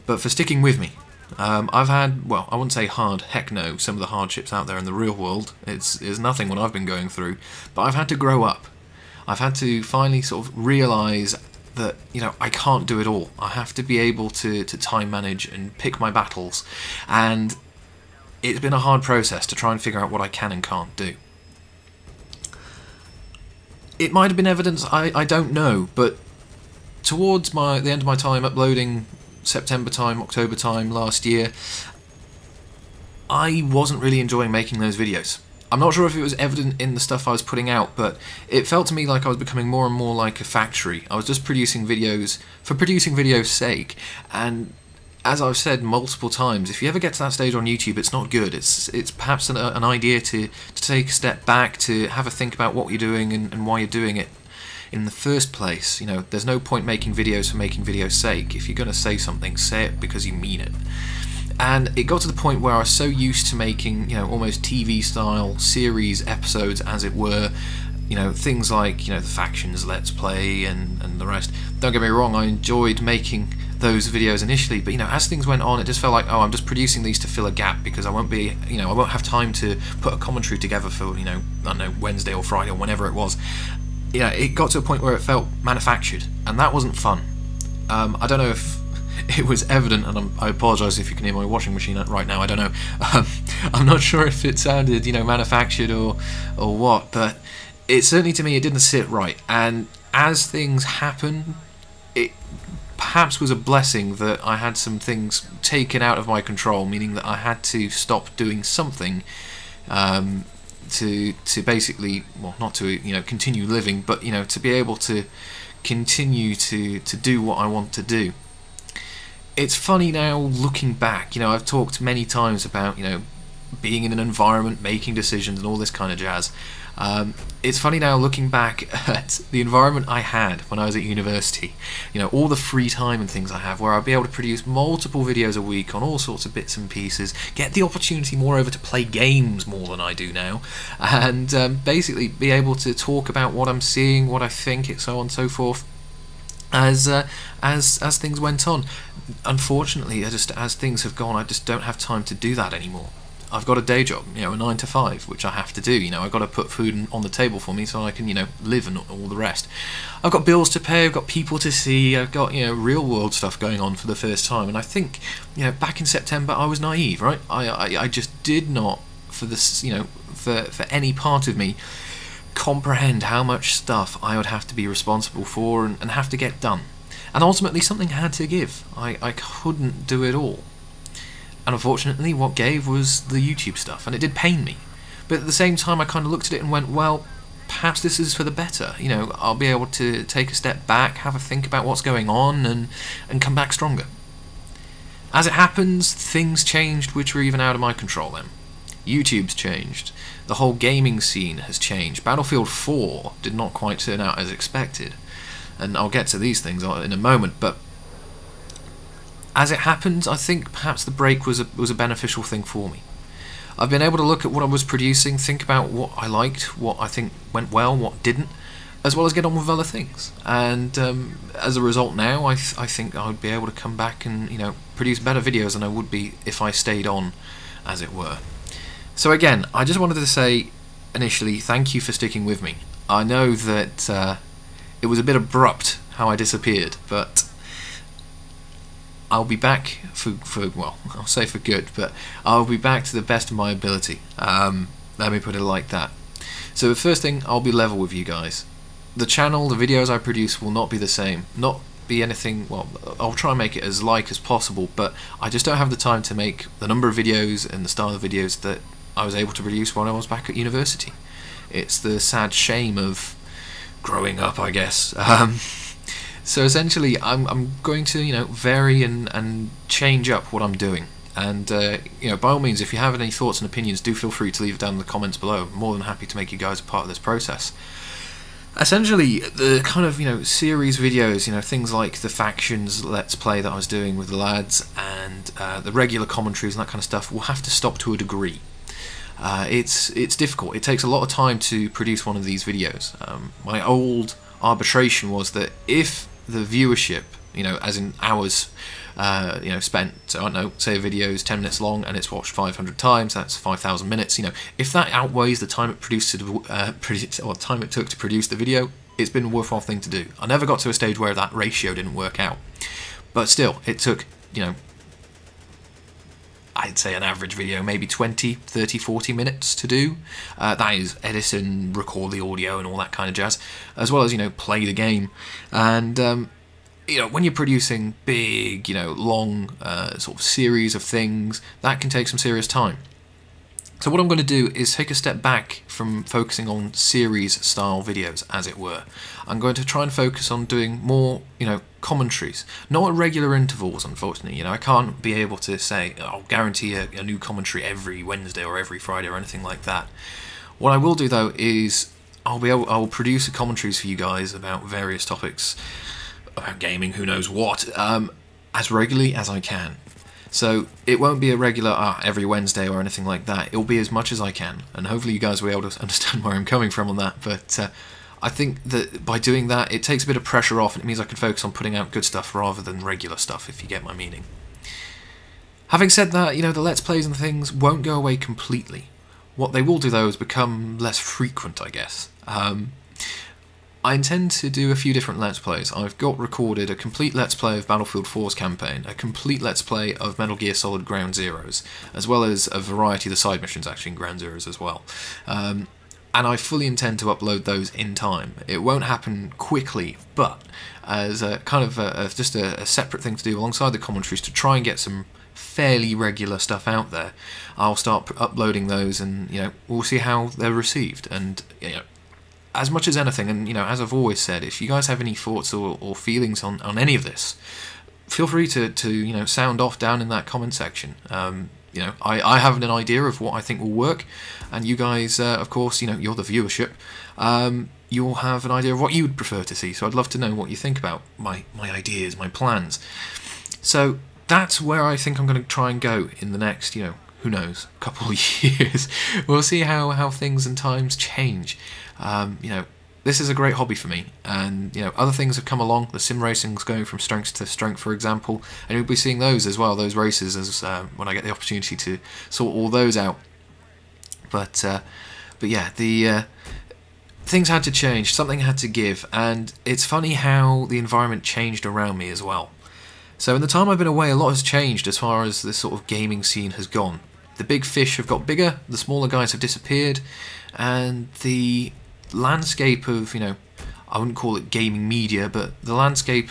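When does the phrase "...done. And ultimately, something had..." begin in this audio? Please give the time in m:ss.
2:56.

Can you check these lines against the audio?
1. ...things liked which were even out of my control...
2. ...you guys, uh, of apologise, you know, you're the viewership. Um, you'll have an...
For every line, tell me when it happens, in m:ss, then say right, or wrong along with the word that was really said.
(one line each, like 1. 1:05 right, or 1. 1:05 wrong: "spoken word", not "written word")
1. 3:16 wrong: "changed", not "liked"
2. 7:04 wrong: "course", not "apologise".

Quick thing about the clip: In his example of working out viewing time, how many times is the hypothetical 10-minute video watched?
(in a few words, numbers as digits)
500.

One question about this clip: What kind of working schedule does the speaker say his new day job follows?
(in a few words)
nine to five.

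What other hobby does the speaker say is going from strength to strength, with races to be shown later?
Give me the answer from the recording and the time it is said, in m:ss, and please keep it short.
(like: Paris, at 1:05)
sim racing, at 7:26.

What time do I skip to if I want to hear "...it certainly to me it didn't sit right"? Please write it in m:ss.
1:37.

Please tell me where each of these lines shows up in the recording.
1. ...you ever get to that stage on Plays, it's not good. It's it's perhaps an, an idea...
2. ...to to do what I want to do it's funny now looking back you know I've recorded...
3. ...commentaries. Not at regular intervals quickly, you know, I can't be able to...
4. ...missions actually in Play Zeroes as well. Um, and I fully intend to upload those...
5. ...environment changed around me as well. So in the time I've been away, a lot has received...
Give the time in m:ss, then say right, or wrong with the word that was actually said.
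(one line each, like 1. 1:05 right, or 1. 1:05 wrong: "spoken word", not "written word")
1. 0:46 wrong: "YouTube", not "Plays"
2. 1:56 wrong: "talked", not "recorded"
3. 5:42 wrong: "unfortunately", not "quickly"
4. 6:33 wrong: "Ground", not "Play"
5. 7:40 wrong: "changed", not "received".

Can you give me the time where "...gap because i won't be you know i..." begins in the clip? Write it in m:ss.
1:17.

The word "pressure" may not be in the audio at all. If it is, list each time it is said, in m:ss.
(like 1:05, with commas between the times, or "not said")
6:10.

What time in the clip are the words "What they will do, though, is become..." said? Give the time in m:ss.
6:19.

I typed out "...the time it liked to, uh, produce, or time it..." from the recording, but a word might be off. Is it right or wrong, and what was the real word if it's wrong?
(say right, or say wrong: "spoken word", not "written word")
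wrong: "produced", not "liked".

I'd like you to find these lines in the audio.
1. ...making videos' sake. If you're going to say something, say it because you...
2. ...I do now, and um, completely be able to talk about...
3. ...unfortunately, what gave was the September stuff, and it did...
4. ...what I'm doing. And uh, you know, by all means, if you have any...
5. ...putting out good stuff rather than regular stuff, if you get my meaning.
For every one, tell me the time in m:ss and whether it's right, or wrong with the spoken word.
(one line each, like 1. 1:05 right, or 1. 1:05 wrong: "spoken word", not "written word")
1. 0:57 right
2. 2:19 wrong: "basically", not "completely"
3. 3:01 wrong: "YouTube", not "September"
4. 4:30 right
5. 6:11 right.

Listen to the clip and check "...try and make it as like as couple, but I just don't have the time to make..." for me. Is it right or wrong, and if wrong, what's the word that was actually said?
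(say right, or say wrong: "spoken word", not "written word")
wrong: "possible", not "couple".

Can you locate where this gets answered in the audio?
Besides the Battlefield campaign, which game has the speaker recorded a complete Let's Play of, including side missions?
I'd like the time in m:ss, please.
6:30.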